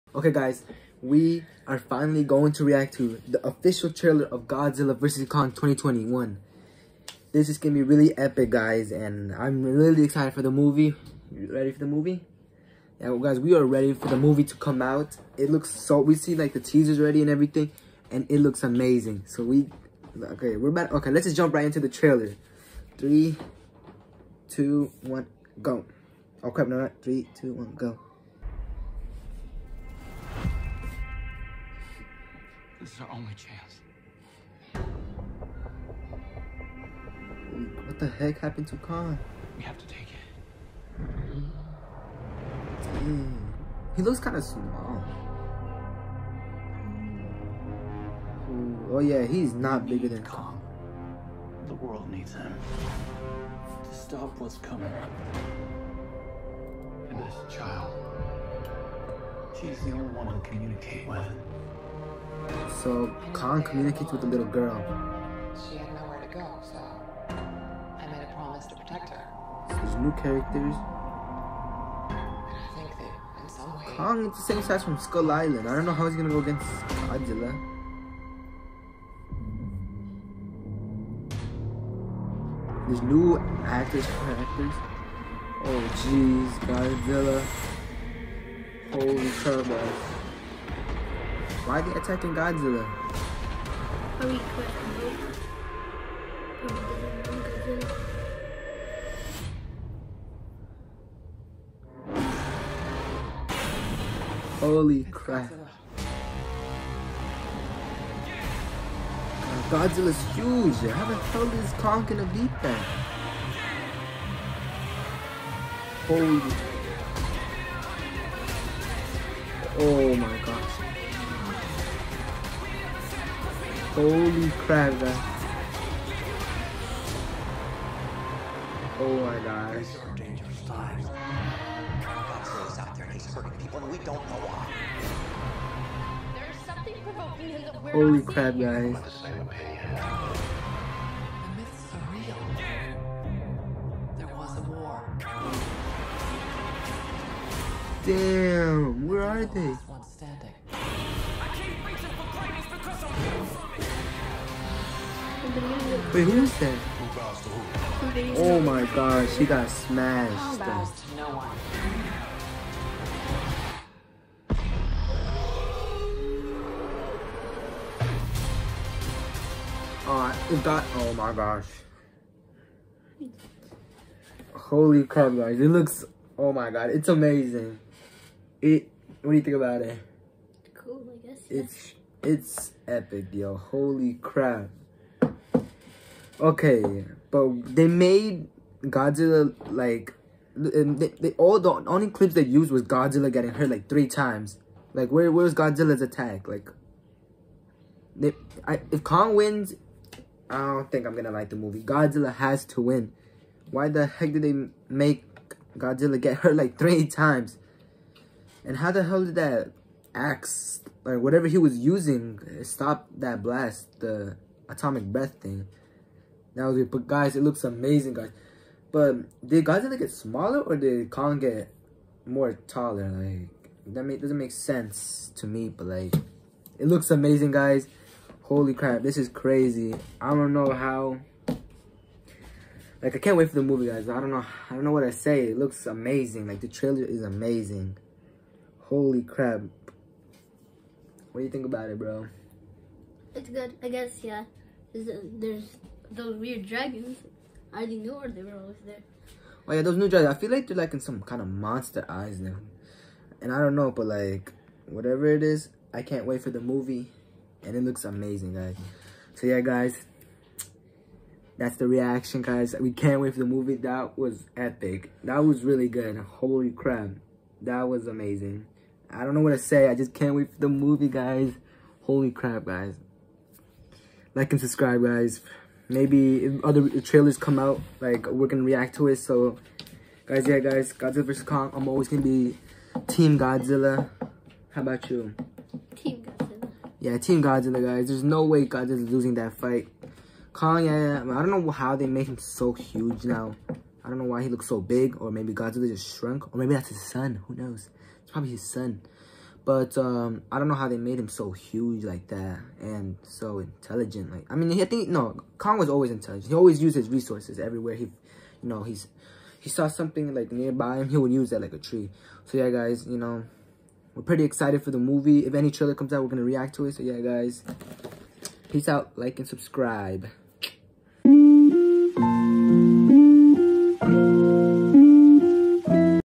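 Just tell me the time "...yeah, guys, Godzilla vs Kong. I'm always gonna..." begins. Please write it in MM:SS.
04:40.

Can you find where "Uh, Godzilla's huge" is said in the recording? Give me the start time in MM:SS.
01:49.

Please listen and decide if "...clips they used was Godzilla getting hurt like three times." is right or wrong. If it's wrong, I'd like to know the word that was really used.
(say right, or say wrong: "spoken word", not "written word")
right.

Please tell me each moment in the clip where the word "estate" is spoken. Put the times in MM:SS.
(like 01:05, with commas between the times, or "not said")
not said.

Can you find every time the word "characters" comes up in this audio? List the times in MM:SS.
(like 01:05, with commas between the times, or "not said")
01:10.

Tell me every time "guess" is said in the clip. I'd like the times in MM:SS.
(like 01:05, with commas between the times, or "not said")
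03:01, 04:03.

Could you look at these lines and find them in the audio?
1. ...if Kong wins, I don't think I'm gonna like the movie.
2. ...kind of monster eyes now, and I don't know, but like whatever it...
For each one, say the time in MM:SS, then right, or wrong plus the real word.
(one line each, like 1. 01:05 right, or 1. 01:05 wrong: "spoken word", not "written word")
1. 03:18 right
2. 04:11 right.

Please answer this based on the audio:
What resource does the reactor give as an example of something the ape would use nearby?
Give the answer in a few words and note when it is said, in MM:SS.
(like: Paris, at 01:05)
A tree, at 05:11.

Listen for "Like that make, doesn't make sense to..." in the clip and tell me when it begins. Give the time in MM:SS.
03:43.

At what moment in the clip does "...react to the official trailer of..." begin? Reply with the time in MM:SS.
00:02.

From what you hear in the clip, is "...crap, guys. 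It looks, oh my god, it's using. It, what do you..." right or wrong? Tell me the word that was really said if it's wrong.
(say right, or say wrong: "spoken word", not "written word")
wrong: "amazing", not "using".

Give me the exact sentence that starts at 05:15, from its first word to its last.
If any trailer comes out, we're gonna react to it.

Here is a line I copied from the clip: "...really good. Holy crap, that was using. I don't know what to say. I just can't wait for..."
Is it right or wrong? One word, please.
wrong.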